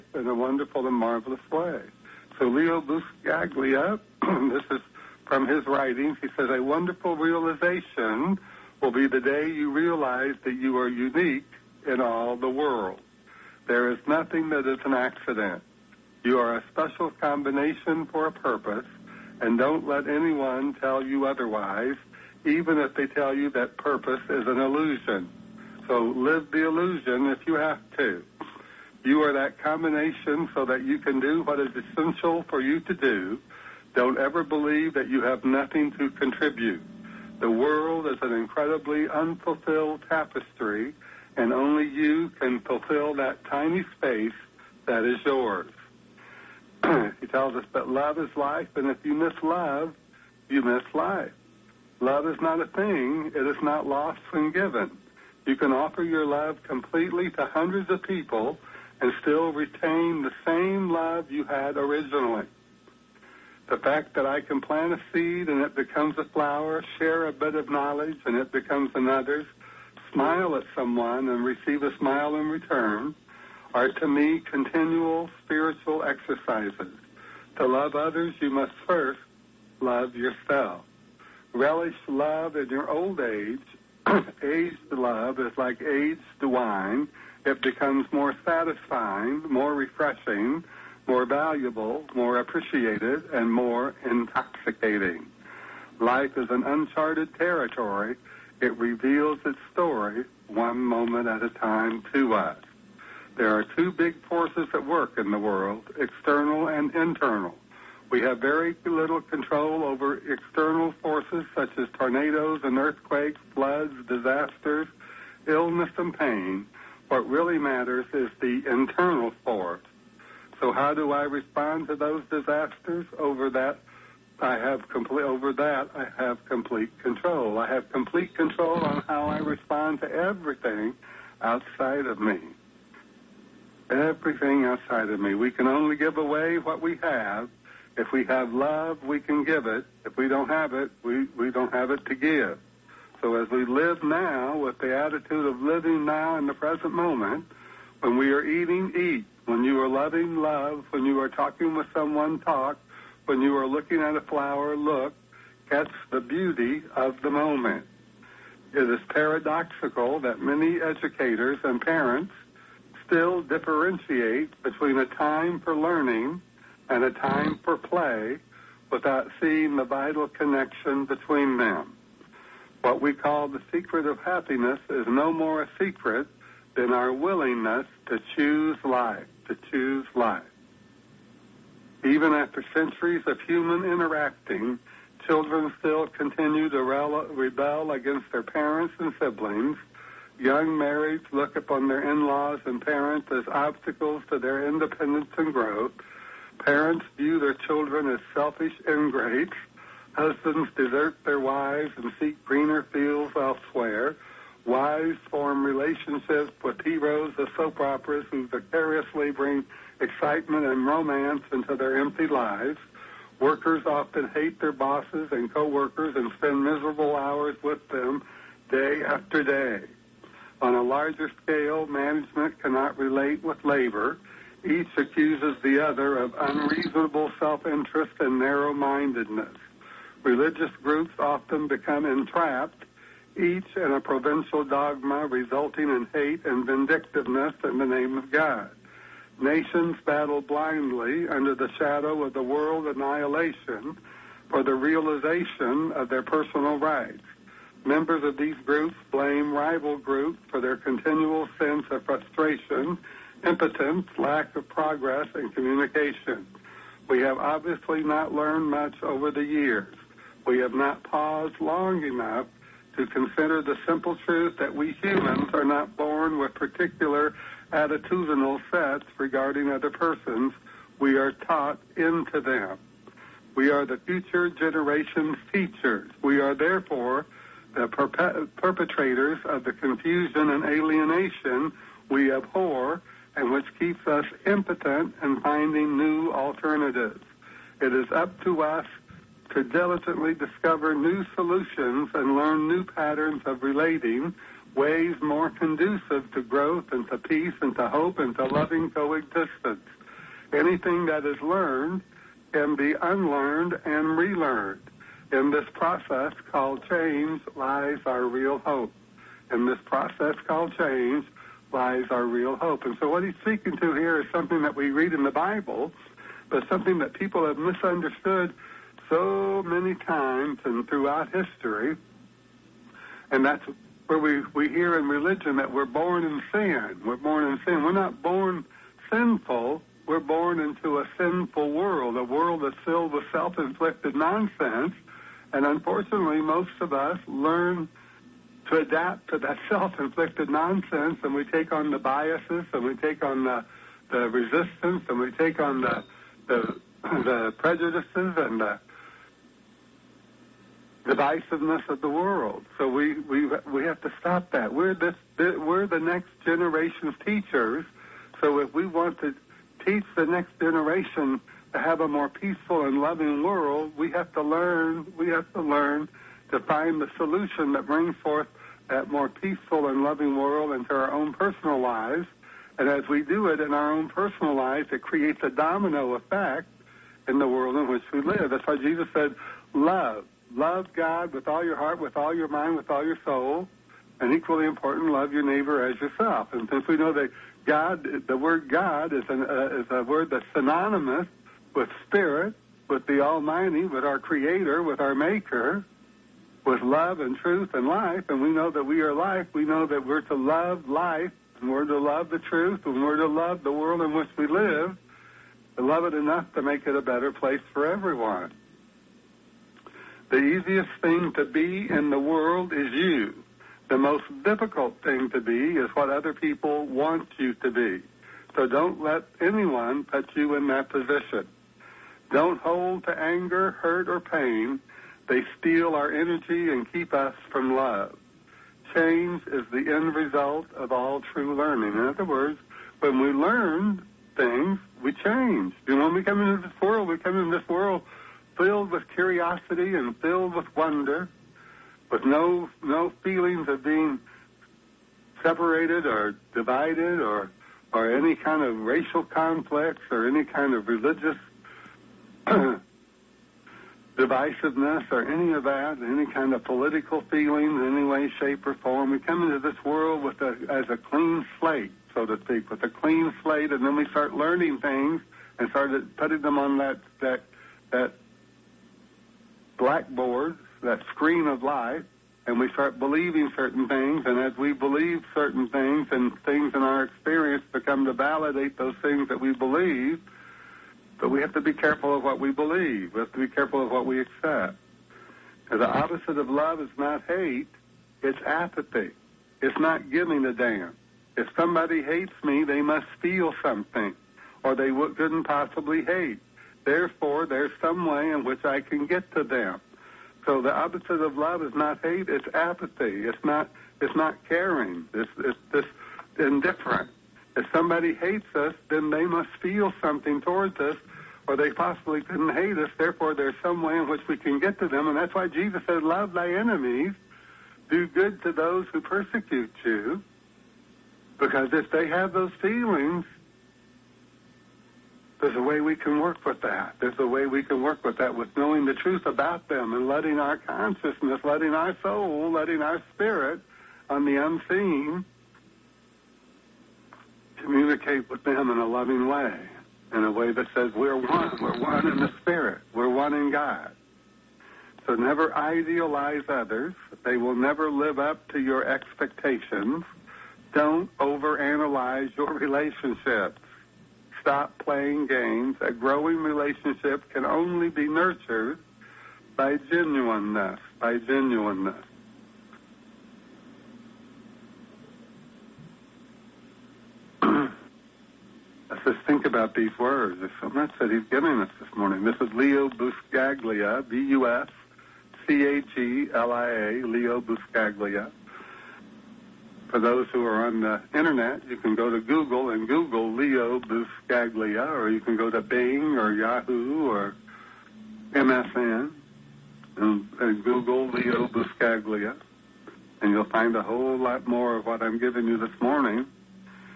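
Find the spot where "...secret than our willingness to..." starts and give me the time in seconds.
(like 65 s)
175 s.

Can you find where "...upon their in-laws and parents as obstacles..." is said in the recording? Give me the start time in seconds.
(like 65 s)
191 s.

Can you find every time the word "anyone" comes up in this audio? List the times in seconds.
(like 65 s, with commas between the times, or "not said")
20 s, 419 s.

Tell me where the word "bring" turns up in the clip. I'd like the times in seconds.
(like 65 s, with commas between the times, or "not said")
209 s, 367 s.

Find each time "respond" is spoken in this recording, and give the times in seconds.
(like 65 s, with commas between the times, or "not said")
121 s, 129 s.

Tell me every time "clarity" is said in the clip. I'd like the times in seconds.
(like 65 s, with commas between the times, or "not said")
not said.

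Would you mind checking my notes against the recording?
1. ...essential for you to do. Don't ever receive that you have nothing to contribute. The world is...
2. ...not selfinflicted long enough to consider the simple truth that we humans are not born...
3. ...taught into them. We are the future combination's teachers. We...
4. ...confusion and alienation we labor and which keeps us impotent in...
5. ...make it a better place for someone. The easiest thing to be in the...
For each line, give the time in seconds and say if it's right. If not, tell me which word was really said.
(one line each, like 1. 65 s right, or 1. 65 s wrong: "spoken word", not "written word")
1. 31 s wrong: "believe", not "receive"
2. 260 s wrong: "paused", not "selfinflicted"
3. 271 s wrong: "generation", not "combination"
4. 279 s wrong: "abhor", not "labor"
5. 406 s wrong: "everyone", not "someone".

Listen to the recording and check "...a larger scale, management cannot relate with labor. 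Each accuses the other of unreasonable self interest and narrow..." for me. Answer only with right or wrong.
right.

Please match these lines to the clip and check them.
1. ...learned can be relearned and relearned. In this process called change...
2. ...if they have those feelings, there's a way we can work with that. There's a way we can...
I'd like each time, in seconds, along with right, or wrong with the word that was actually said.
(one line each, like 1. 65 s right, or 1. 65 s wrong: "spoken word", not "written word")
1. 301 s wrong: "unlearned", not "relearned"
2. 521 s right.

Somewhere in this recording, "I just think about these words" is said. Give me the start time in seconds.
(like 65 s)
568 s.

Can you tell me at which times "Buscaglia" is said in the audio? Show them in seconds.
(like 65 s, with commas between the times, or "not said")
2 s, 572 s, 577 s, 583 s, 591 s.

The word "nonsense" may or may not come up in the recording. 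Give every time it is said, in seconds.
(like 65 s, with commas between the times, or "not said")
334 s, 340 s.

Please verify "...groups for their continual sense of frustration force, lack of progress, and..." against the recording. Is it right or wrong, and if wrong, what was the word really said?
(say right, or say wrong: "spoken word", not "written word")
wrong: "impotence", not "force".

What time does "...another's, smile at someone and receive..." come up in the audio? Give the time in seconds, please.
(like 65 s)
68 s.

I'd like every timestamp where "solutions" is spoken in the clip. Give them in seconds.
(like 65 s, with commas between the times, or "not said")
291 s, 367 s.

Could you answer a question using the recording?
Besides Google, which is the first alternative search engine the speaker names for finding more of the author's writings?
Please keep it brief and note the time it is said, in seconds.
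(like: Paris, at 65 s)
Bing, at 585 s.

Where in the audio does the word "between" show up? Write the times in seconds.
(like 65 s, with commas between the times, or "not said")
164 s, 171 s.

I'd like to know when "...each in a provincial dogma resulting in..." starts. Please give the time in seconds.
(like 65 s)
233 s.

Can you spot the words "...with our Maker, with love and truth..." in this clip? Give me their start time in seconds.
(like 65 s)
394 s.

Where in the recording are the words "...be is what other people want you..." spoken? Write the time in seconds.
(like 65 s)
415 s.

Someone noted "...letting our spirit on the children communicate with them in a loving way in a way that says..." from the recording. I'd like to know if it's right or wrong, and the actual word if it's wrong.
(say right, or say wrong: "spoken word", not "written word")
wrong: "unseen", not "children".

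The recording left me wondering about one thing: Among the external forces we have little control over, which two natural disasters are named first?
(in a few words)
Tornadoes and earthquakes.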